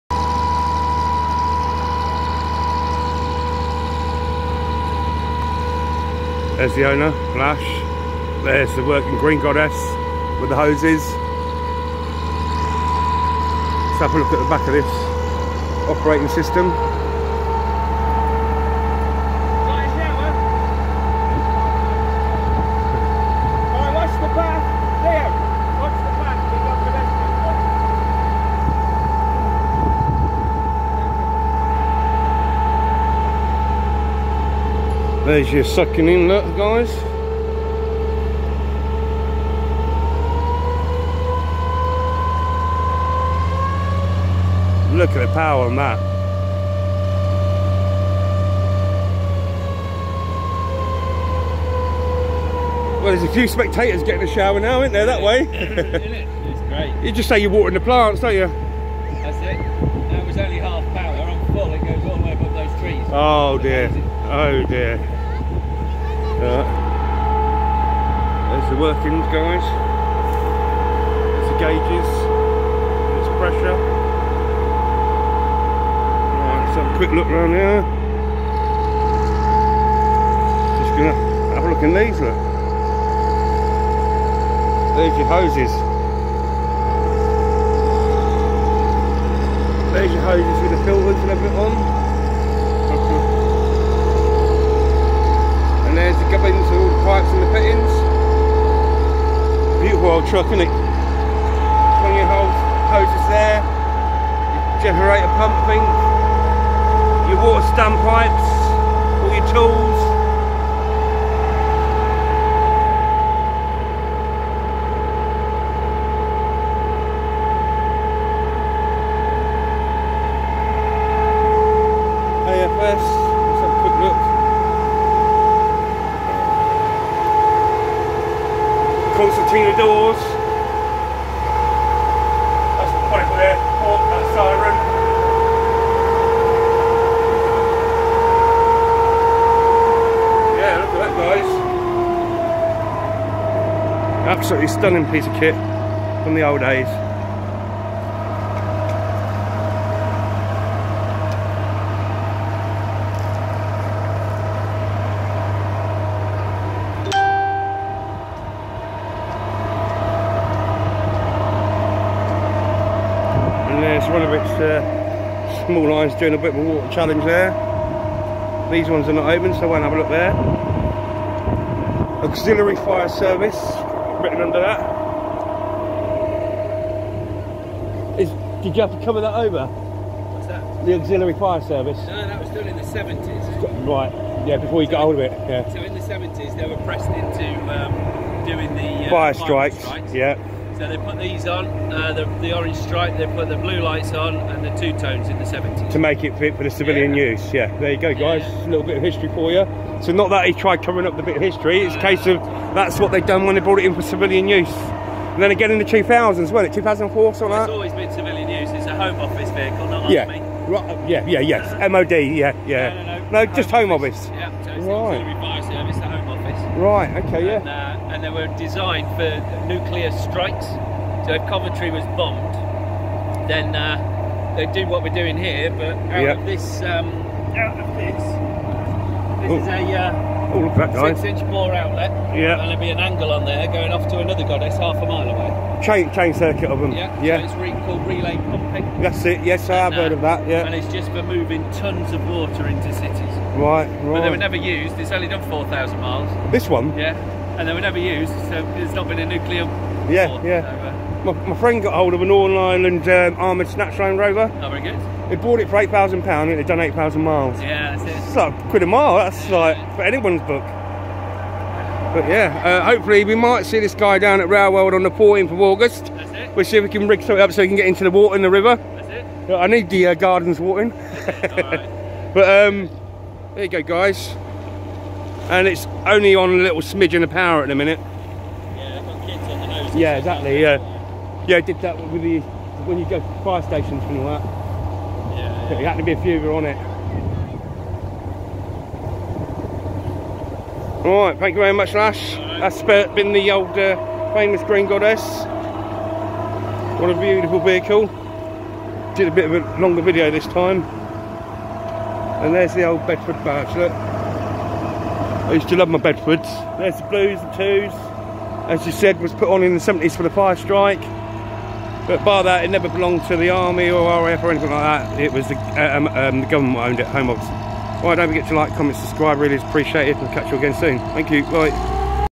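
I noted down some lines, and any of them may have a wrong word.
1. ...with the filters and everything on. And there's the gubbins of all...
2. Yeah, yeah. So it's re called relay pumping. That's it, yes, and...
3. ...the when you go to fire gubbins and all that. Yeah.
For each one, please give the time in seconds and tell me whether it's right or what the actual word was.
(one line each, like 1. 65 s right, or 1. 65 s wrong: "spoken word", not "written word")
1. 90 s right
2. 236 s right
3. 282 s wrong: "stations", not "gubbins".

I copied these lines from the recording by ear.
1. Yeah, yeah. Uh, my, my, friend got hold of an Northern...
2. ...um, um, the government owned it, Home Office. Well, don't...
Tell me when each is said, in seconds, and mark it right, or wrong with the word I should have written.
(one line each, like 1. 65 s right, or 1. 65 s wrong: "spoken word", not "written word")
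1. 250 s right
2. 315 s right.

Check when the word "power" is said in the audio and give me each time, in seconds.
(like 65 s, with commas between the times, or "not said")
45 s, 60 s, 277 s.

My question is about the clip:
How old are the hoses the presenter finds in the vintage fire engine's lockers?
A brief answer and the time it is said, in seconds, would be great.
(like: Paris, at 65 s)
20 years, at 100 s.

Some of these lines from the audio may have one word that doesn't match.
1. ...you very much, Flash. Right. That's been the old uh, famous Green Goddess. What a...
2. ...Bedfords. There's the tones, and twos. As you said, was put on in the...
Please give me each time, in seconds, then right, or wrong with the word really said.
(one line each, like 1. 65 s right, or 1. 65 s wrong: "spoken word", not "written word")
1. 291 s wrong: "Lash", not "Flash"
2. 305 s wrong: "blues", not "tones".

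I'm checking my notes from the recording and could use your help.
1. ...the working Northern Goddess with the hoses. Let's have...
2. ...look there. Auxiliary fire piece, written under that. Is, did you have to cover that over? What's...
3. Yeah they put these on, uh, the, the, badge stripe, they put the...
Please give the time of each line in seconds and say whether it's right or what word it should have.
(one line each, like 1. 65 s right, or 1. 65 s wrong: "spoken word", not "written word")
1. 8 s wrong: "Green", not "Northern"
2. 169 s wrong: "service", not "piece"
3. 190 s wrong: "orange", not "badge".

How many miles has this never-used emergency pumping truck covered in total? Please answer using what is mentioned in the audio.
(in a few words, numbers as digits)
4,000.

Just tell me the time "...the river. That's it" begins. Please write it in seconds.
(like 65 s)
268 s.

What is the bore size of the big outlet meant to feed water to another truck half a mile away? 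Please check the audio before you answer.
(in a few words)
6 inch.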